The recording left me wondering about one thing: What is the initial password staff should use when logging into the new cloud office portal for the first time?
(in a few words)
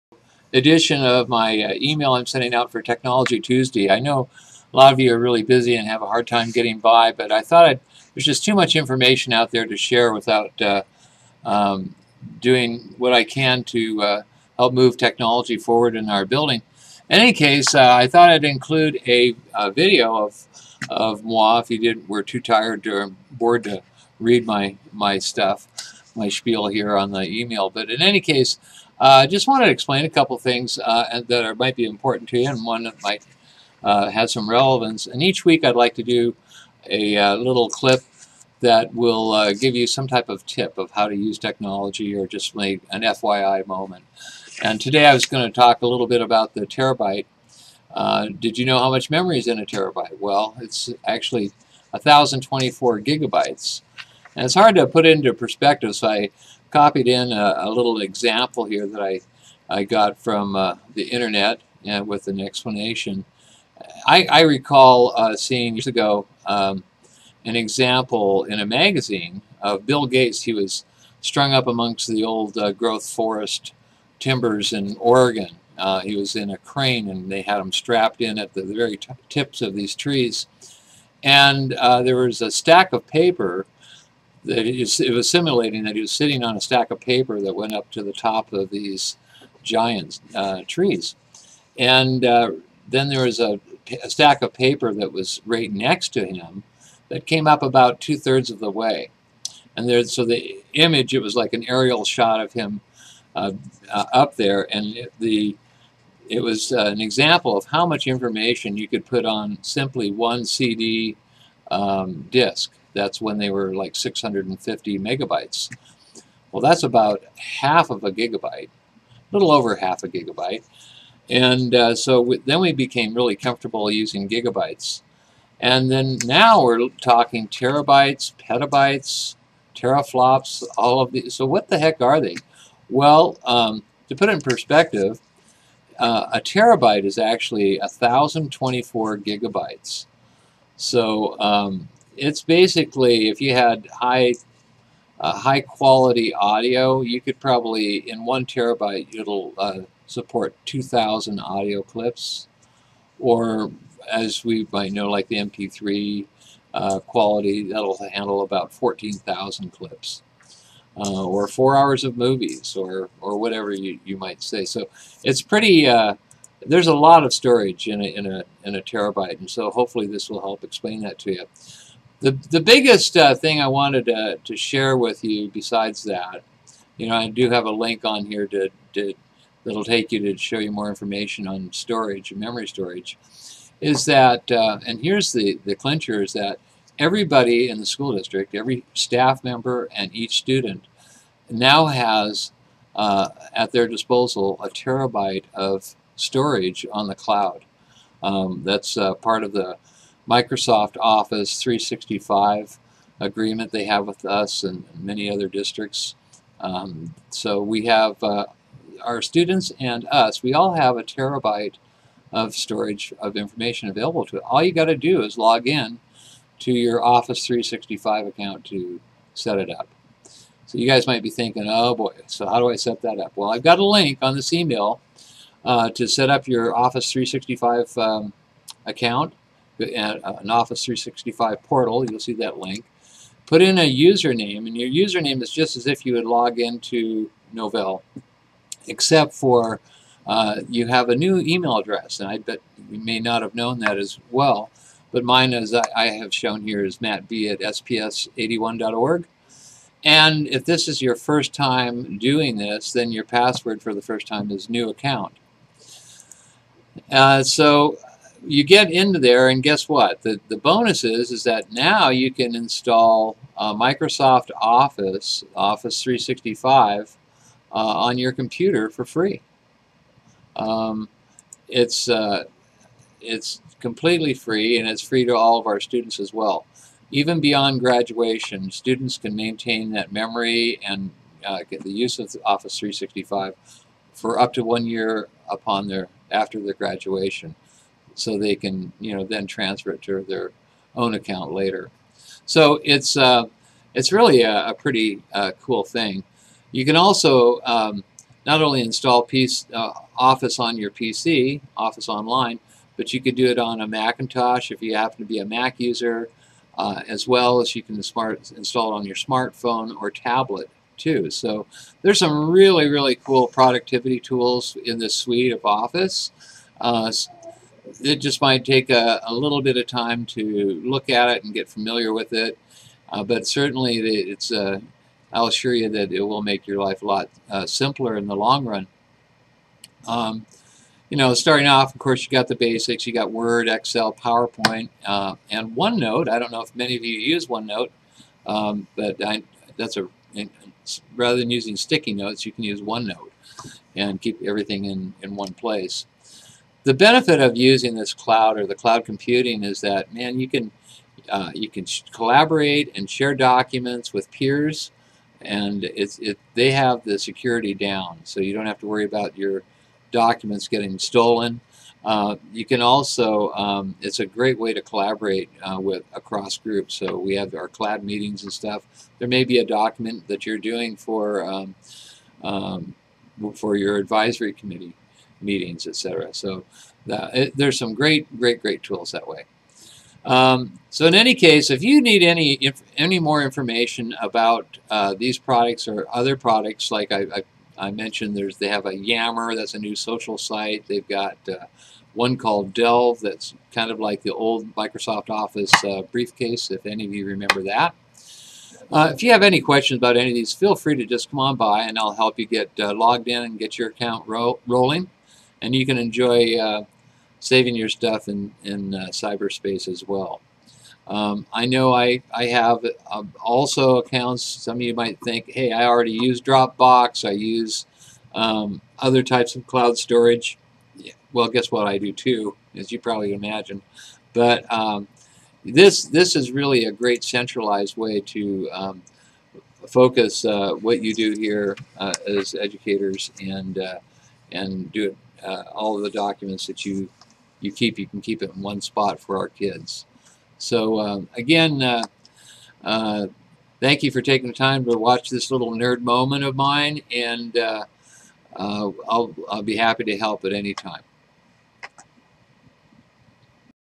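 new account.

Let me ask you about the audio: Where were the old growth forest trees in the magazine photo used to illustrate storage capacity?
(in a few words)
Oregon.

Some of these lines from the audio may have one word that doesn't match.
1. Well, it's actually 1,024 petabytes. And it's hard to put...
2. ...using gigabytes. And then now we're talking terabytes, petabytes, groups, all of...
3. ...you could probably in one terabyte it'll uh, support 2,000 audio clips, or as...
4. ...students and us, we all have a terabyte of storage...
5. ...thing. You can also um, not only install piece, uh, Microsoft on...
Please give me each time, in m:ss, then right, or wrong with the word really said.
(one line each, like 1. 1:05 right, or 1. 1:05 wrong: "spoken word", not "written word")
1. 0:50 wrong: "gigabytes", not "petabytes"
2. 2:03 wrong: "teraflops", not "groups"
3. 2:27 right
4. 3:29 right
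5. 4:55 wrong: "Office", not "Microsoft".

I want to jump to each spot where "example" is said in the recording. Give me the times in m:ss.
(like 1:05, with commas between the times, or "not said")
0:58, 1:07, 1:46.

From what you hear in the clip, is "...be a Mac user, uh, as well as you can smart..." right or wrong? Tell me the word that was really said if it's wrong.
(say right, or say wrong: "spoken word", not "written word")
right.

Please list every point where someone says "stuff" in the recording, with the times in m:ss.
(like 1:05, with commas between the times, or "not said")
0:25, 6:08, 6:47.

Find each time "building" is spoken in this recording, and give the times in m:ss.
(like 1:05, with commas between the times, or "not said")
0:16.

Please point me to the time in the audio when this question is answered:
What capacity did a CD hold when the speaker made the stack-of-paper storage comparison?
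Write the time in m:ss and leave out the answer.
1:53.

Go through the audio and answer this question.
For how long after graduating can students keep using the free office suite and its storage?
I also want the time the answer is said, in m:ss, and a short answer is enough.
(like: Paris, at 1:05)
one year, at 4:44.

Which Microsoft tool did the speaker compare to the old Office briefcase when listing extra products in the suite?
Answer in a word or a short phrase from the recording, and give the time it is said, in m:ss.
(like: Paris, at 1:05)
Delve, at 6:32.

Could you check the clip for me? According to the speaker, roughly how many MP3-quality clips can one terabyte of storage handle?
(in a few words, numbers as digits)
14,000.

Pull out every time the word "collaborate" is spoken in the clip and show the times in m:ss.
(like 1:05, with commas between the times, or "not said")
5:52, 6:04.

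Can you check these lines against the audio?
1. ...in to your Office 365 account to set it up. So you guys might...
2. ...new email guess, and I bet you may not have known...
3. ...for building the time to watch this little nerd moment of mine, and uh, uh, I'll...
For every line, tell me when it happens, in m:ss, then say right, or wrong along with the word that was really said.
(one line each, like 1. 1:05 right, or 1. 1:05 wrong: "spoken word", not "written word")
1. 3:35 right
2. 4:01 wrong: "address", not "guess"
3. 7:24 wrong: "taking", not "building".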